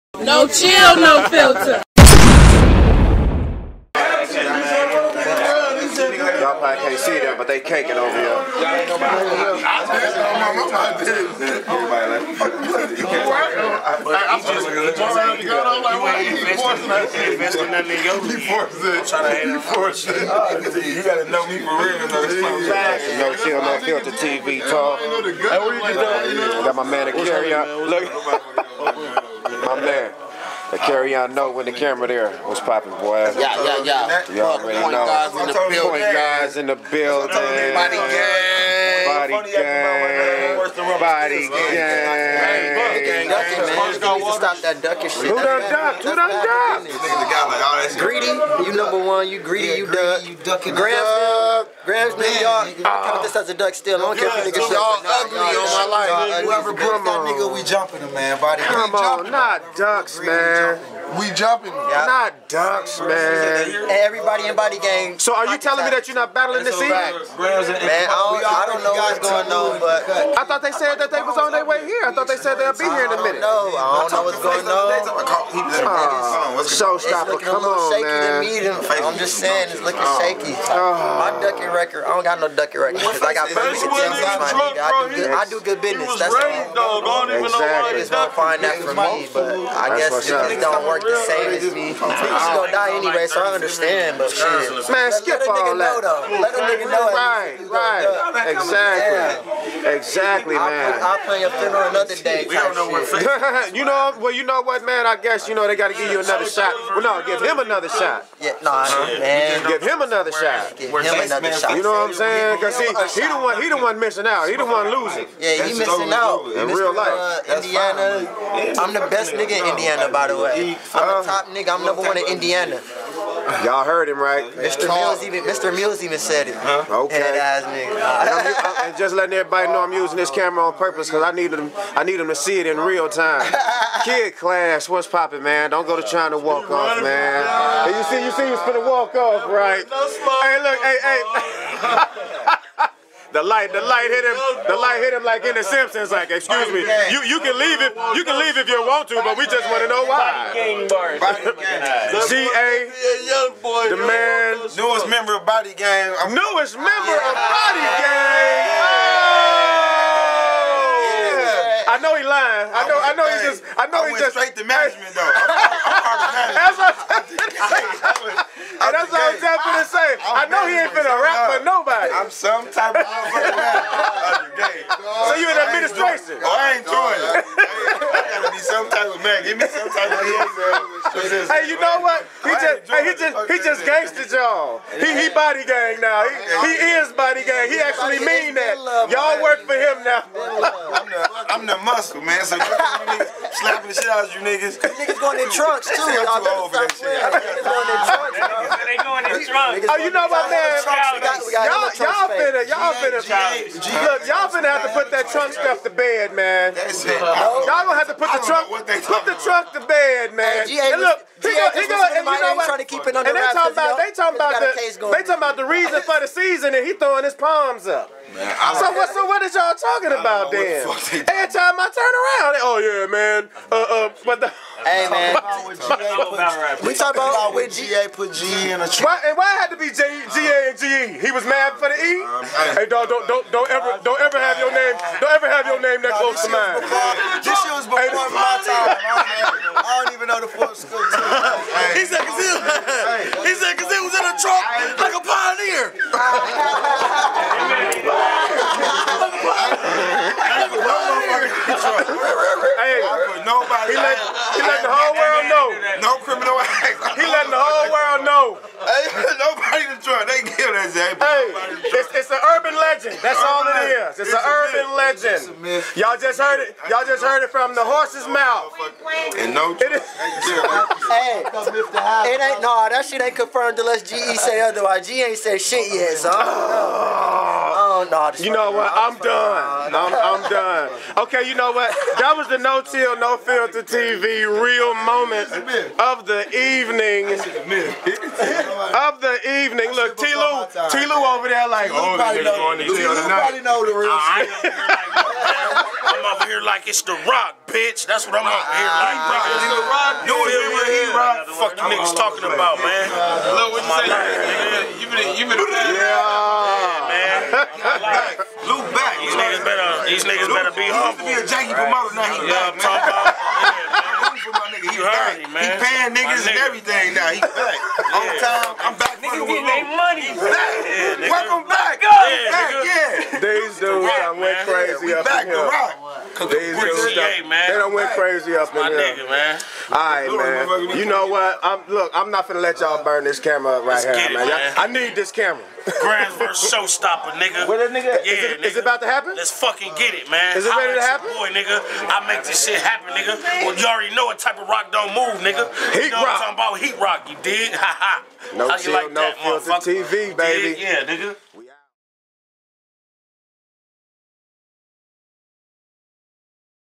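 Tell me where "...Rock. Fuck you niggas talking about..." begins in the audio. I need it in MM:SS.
05:01.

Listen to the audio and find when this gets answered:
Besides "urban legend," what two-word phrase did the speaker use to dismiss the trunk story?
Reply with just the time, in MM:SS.
04:24.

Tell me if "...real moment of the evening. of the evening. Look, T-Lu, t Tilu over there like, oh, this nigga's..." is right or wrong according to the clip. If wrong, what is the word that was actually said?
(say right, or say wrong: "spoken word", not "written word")
right.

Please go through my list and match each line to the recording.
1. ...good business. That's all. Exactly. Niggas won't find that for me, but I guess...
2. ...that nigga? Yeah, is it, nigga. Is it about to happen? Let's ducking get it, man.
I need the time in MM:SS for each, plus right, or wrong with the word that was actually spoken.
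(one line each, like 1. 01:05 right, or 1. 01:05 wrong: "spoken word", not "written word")
1. 01:25 right
2. 05:37 wrong: "fucking", not "ducking".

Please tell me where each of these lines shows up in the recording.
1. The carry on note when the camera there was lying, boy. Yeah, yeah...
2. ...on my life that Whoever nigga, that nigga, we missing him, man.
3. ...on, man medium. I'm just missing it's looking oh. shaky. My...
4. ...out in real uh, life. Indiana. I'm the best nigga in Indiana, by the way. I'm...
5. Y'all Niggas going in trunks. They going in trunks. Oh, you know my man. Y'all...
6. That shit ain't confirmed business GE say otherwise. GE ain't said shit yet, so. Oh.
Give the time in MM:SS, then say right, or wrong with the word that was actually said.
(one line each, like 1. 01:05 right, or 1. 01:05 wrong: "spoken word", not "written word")
1. 00:30 wrong: "popping", not "lying"
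2. 00:55 wrong: "jumping", not "missing"
3. 01:17 wrong: "saying", not "missing"
4. 01:56 right
5. 03:16 right
6. 04:32 wrong: "unless", not "business".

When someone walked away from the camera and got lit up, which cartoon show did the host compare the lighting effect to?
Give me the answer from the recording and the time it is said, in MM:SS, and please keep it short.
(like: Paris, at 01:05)
The Simpsons, at 02:25.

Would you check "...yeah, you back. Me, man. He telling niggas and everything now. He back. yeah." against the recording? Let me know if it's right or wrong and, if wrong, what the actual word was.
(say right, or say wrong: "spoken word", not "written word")
wrong: "paying", not "telling".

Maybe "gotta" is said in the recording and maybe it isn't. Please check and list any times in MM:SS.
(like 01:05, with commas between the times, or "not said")
00:15, 02:58.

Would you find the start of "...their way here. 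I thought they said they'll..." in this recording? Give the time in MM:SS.
01:11.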